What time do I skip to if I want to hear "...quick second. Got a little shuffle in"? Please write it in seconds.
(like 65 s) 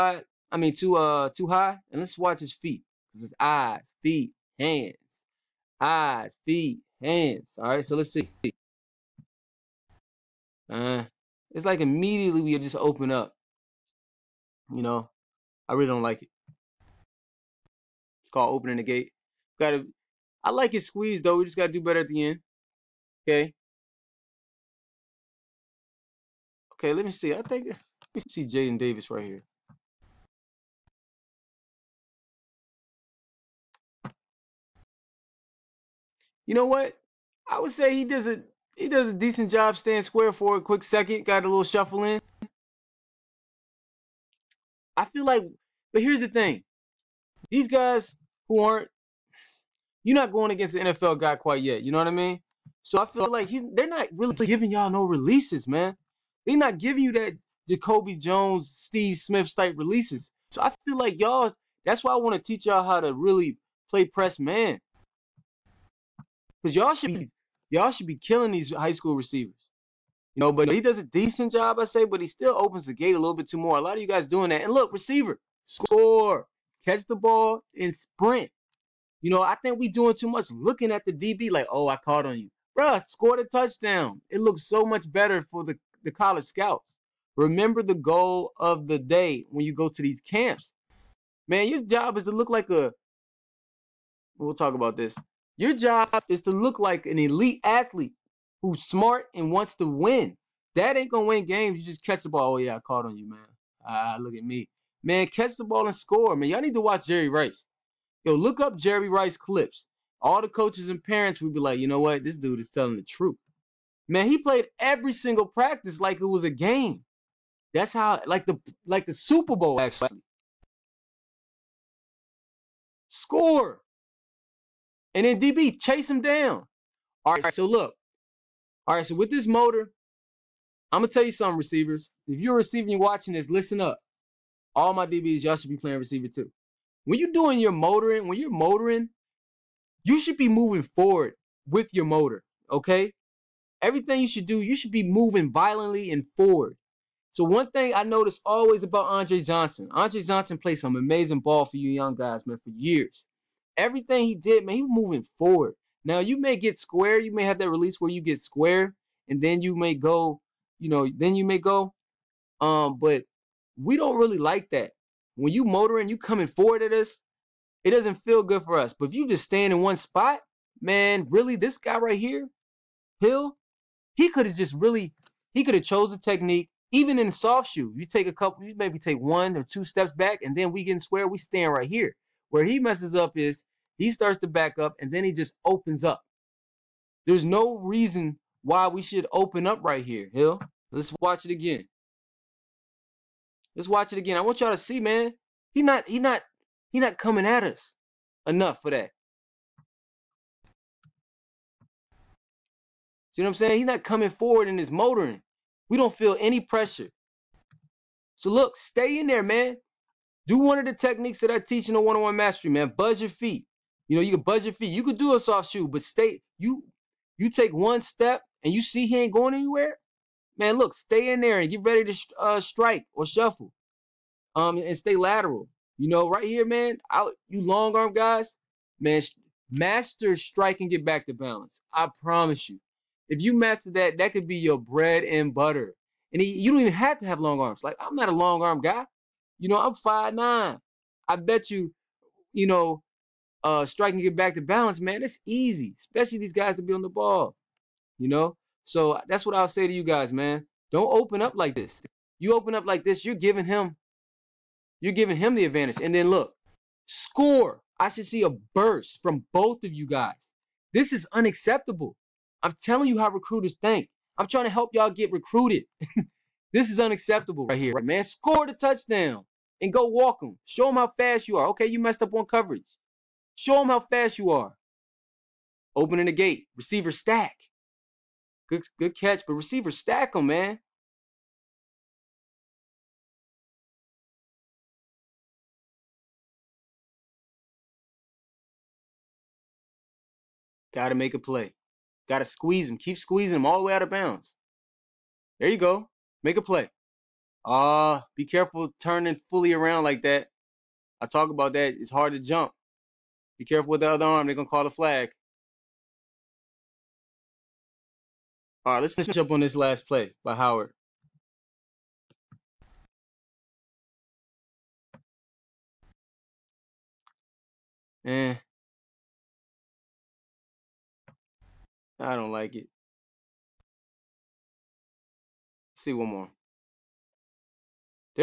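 40 s.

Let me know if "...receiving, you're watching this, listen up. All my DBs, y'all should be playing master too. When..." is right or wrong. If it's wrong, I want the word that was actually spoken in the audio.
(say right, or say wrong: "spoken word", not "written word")
wrong: "receiver", not "master".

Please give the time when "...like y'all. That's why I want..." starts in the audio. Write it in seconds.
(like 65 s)
60 s.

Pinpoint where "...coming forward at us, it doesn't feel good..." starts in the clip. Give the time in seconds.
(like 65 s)
166 s.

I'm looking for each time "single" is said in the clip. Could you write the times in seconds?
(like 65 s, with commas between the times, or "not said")
115 s.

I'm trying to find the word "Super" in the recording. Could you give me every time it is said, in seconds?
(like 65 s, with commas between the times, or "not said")
119 s.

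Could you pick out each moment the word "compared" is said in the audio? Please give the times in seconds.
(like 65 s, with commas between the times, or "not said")
not said.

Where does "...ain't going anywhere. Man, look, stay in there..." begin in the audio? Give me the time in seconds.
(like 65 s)
219 s.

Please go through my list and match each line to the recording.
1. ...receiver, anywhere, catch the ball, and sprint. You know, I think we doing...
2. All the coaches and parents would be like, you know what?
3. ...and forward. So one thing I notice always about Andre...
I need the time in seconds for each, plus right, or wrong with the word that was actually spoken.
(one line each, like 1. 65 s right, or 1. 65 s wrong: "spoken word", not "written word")
1. 74 s wrong: "score", not "anywhere"
2. 110 s right
3. 146 s right.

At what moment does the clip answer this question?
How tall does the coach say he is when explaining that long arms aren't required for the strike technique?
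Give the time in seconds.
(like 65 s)
239 s.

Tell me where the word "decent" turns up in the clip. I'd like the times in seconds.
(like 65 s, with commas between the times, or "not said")
39 s, 71 s.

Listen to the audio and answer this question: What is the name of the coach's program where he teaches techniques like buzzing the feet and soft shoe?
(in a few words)
One-on-one mastery.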